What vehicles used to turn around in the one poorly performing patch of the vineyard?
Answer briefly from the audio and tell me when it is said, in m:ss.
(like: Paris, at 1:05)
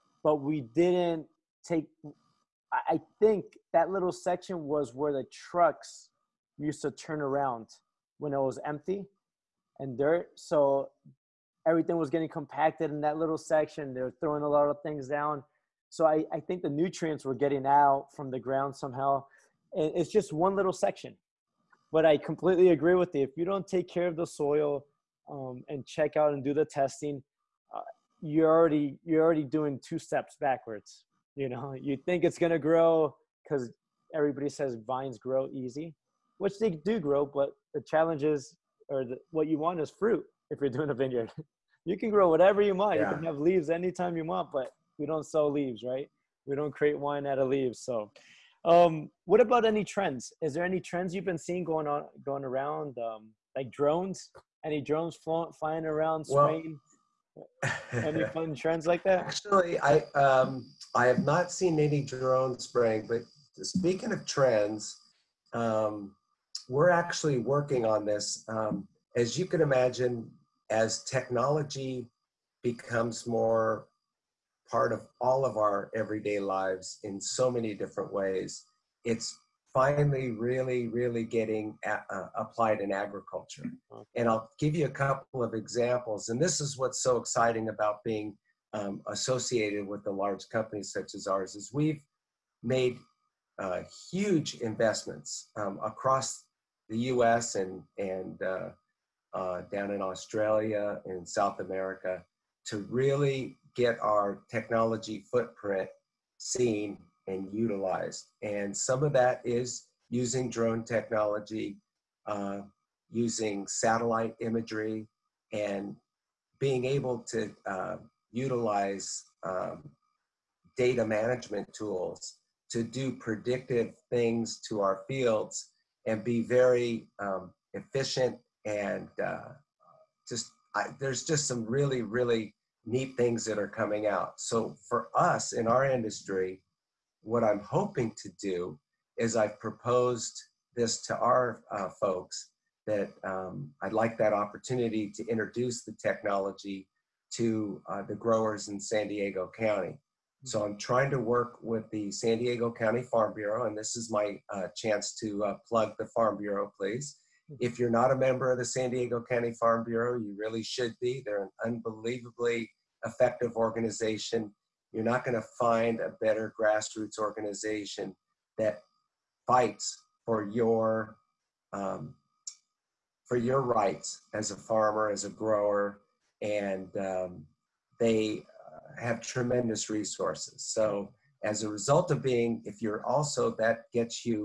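Trucks, at 0:05.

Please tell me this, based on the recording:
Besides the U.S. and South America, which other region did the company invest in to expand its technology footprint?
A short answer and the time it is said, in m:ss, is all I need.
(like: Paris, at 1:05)
Australia, at 1:40.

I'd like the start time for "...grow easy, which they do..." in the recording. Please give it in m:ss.
0:35.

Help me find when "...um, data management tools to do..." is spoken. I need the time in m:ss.
1:59.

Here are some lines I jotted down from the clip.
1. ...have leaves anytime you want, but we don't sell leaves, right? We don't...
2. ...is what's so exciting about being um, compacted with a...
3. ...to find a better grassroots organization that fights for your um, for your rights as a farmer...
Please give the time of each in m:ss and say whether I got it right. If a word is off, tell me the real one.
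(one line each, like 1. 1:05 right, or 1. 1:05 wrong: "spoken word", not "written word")
1. 0:43 right
2. 1:26 wrong: "associated", not "compacted"
3. 2:45 right.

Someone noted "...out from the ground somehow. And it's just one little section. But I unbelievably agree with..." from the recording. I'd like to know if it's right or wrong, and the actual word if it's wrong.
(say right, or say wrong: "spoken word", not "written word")
wrong: "completely", not "unbelievably".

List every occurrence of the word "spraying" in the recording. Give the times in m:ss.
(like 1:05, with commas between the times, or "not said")
0:56, 1:02.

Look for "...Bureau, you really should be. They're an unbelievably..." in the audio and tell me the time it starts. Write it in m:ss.
2:39.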